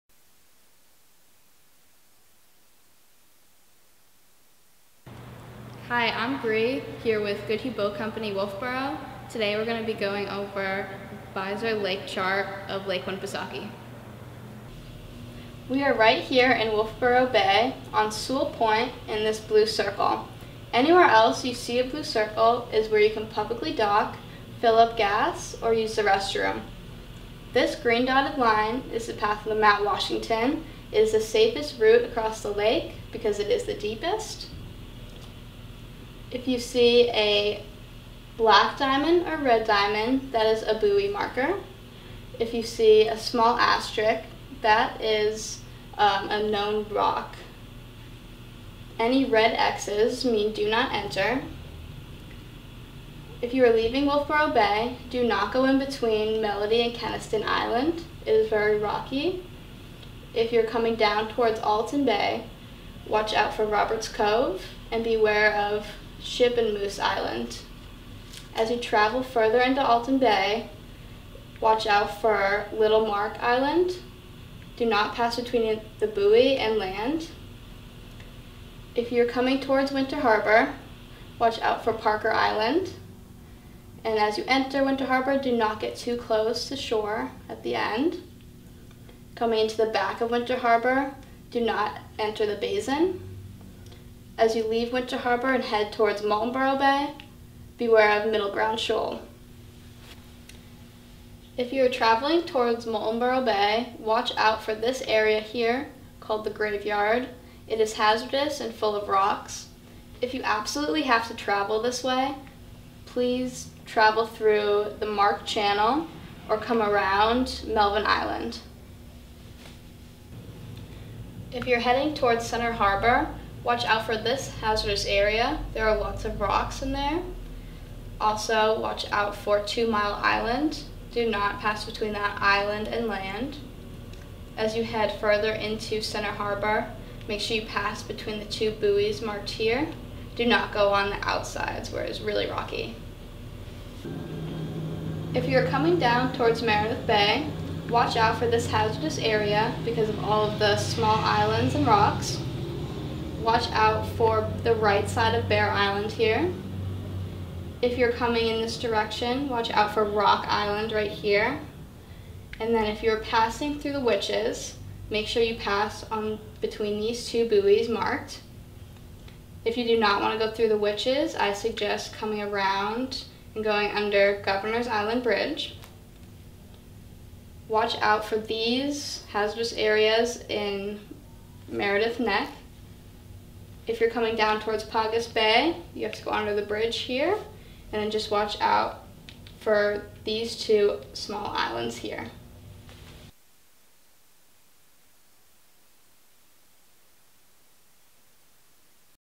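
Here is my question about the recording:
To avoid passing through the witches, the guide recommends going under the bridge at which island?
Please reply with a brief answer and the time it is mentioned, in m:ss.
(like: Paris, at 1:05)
Governor's Island, at 2:54.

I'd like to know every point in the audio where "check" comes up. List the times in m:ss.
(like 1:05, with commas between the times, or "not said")
not said.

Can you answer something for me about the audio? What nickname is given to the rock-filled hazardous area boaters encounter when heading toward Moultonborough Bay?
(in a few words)
the graveyard.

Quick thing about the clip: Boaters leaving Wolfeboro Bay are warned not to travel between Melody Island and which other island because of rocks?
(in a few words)
Keniston Island.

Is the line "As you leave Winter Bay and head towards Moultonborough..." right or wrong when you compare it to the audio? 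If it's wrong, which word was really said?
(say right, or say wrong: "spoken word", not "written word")
wrong: "Harbor", not "Bay".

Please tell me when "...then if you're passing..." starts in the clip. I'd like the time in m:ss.
2:42.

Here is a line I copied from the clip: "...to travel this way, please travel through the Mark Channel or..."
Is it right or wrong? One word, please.
right.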